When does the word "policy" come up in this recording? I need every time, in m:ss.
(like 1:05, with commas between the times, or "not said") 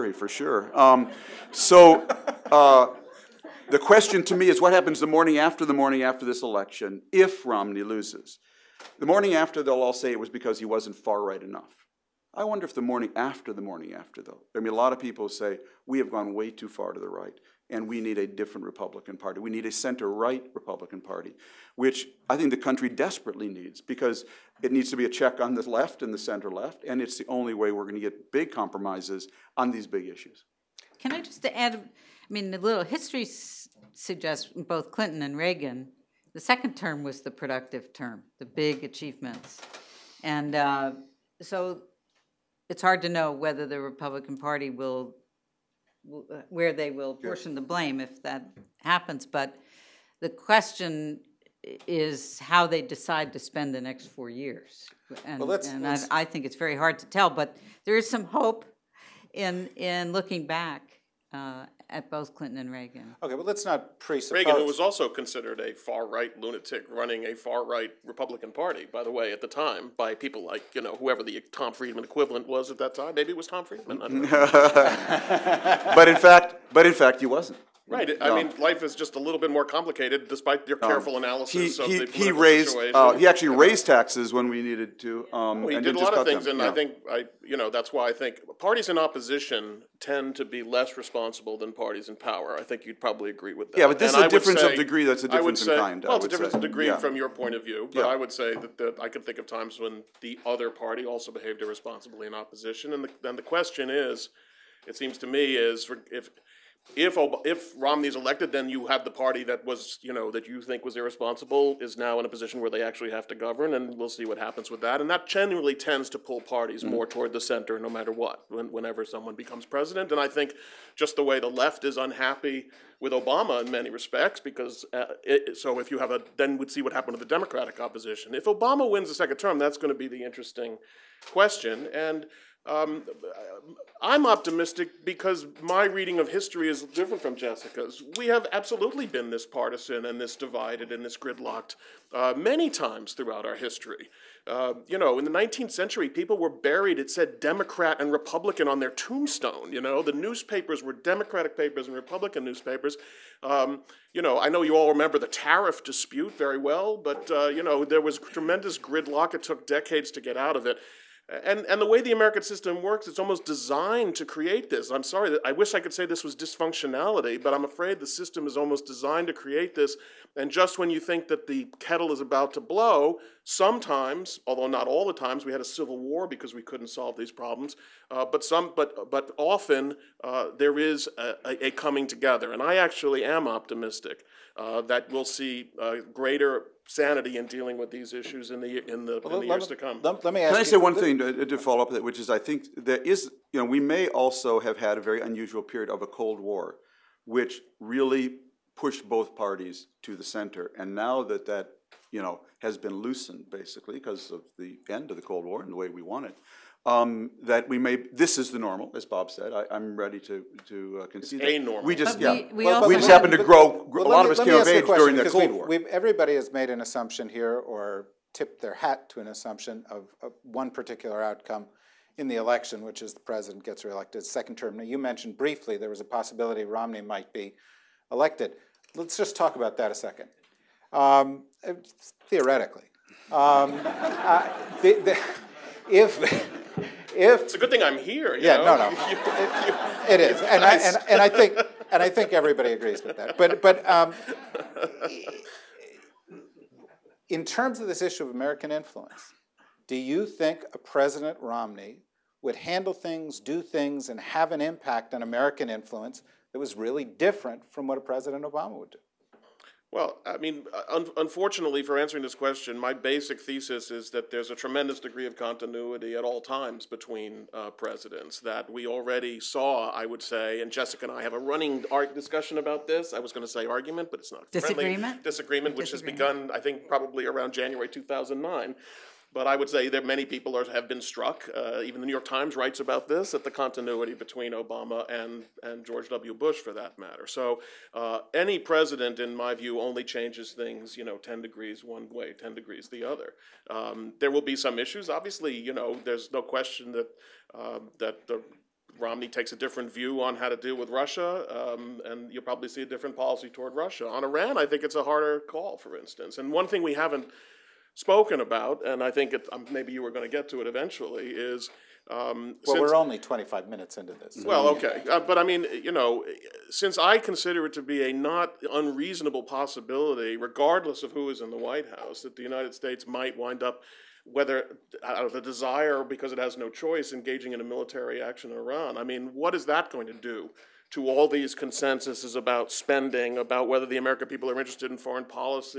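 5:03, 5:35.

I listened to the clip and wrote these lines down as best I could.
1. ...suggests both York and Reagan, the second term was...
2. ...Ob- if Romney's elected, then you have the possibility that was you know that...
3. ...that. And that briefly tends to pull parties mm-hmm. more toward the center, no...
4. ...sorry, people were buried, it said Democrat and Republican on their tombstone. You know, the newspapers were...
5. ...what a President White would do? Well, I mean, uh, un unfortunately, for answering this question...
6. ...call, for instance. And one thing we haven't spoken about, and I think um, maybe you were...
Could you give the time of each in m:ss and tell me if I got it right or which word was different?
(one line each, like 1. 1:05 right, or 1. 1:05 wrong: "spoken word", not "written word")
1. 0:33 wrong: "Clinton", not "York"
2. 1:47 wrong: "party", not "possibility"
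3. 1:54 wrong: "generally", not "briefly"
4. 2:25 wrong: "century", not "sorry"
5. 4:17 wrong: "Obama", not "White"
6. 5:05 right.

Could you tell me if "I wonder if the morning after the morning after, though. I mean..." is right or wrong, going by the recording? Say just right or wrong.
right.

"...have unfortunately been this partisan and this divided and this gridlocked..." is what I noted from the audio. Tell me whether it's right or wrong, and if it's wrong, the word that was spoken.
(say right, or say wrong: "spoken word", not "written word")
wrong: "absolutely", not "unfortunately".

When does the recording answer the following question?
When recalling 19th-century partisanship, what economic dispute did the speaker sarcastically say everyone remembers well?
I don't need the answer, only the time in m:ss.
2:35.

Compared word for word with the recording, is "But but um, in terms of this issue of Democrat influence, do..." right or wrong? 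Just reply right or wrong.
wrong.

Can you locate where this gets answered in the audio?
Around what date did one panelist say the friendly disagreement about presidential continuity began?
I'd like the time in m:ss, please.
4:37.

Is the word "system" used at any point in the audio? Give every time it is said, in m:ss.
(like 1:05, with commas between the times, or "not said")
2:42, 2:48.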